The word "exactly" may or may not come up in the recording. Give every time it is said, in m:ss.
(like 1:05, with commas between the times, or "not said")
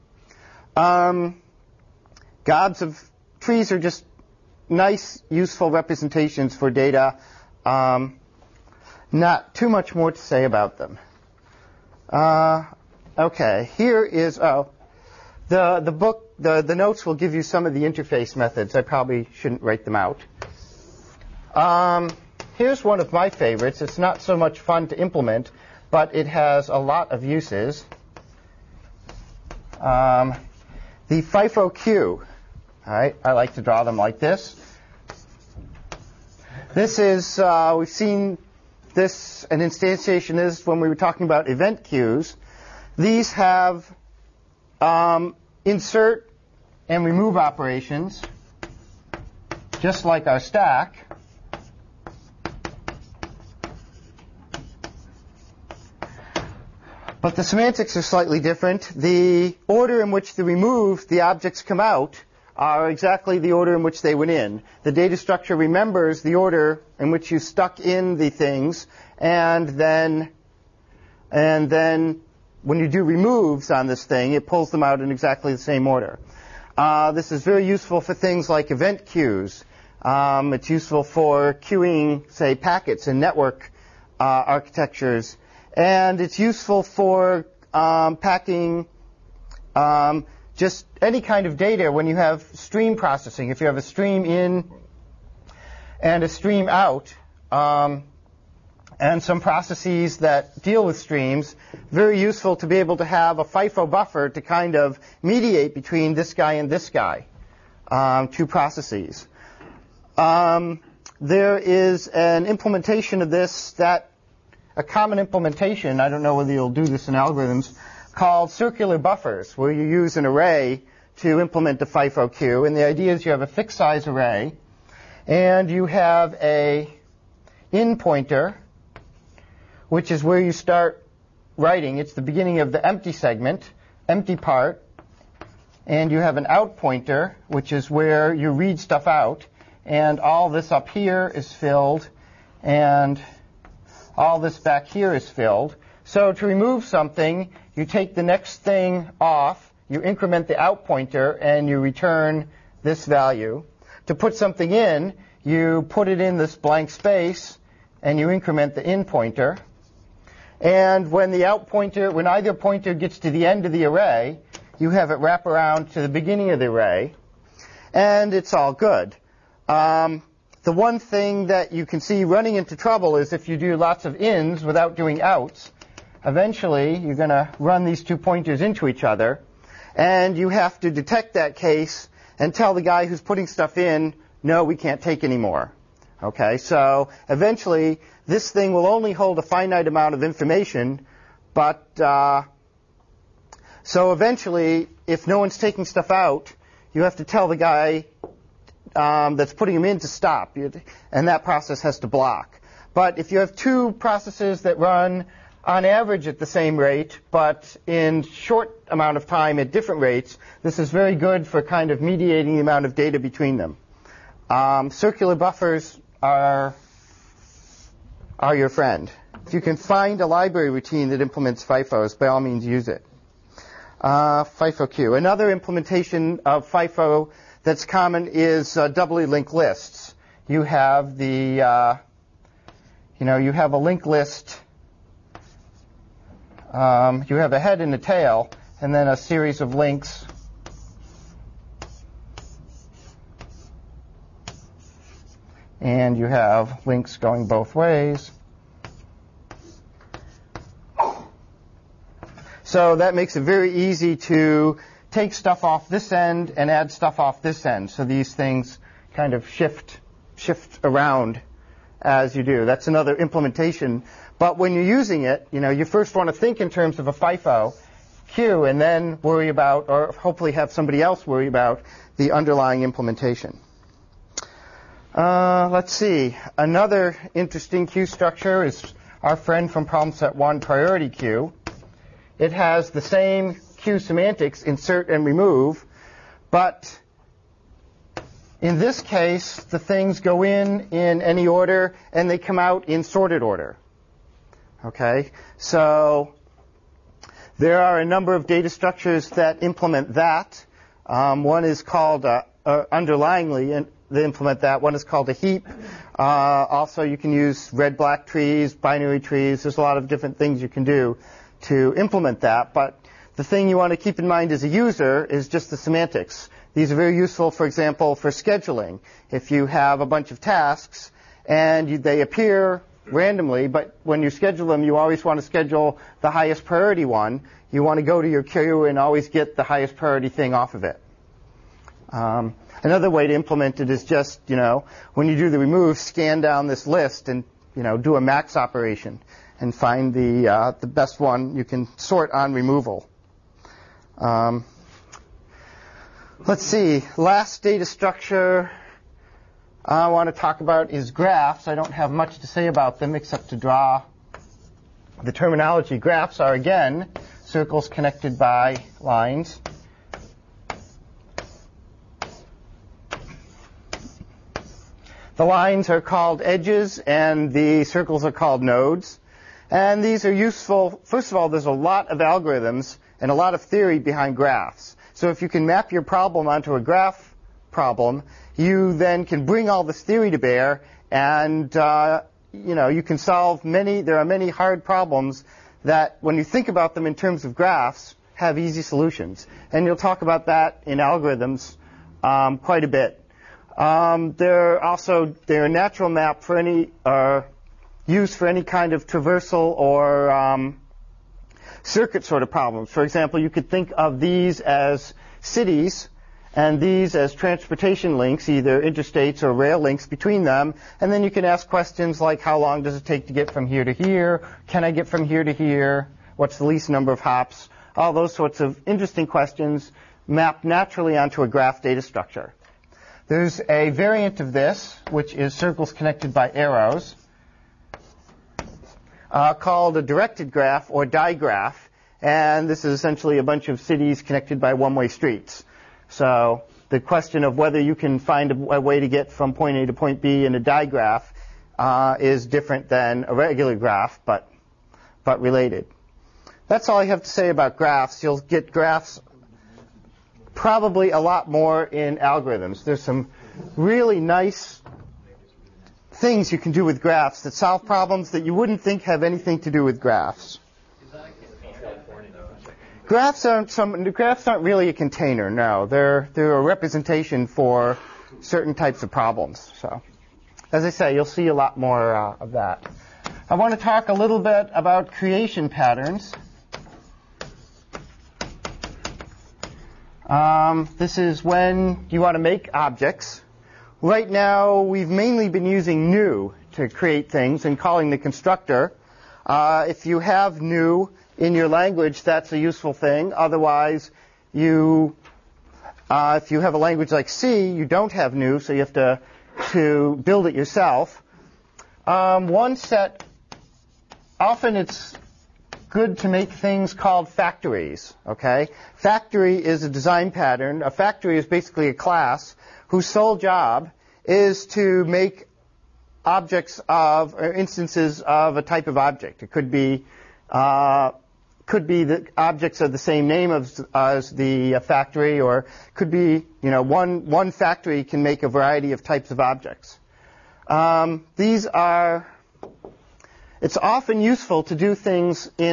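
1:02, 1:15.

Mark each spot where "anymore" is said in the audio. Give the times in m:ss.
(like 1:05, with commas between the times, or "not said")
3:05.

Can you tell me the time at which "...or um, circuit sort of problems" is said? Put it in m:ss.
6:39.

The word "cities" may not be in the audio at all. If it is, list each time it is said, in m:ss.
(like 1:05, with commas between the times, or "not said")
6:45, 7:13.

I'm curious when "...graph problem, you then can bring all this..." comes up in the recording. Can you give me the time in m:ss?
6:16.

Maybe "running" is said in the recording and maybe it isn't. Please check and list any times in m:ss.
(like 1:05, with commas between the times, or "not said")
2:52.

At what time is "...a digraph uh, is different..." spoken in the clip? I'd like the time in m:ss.
7:20.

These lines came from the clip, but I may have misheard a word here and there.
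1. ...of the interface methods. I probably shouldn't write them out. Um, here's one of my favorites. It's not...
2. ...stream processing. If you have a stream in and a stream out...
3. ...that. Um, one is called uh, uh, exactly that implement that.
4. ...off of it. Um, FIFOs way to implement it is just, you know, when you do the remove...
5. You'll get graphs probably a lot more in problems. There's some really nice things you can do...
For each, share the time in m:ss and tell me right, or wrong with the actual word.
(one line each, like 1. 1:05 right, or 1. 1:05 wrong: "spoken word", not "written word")
1. 0:17 right
2. 1:32 right
3. 5:00 wrong: "underlyingly", not "exactly"
4. 5:30 wrong: "Another", not "FIFOs"
5. 7:28 wrong: "algorithms", not "problems".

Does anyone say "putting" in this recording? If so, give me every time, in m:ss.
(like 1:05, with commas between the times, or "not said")
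3:03, 3:19.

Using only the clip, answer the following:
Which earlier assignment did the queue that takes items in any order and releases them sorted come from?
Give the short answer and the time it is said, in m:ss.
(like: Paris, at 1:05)
problem set one, at 4:39.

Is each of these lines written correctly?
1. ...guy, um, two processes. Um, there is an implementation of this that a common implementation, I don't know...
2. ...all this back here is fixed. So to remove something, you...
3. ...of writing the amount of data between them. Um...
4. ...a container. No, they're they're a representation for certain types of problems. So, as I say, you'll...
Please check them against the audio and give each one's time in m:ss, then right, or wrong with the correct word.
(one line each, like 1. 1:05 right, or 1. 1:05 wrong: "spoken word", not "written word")
1. 1:46 right
2. 2:24 wrong: "filled", not "fixed"
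3. 3:31 wrong: "mediating", not "writing"
4. 7:44 right.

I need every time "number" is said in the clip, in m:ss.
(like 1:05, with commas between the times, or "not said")
4:58, 6:56.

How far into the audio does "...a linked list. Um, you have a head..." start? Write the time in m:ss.
3:53.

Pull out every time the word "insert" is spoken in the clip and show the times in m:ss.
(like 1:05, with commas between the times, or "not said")
0:45, 4:44.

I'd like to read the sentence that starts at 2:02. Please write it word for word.
And the idea is you have a fixed size array, and you have a in pointer which is where you start writing.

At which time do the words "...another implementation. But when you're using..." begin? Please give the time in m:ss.
4:22.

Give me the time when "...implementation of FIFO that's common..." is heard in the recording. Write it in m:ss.
3:45.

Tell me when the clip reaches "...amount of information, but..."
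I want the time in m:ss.
3:09.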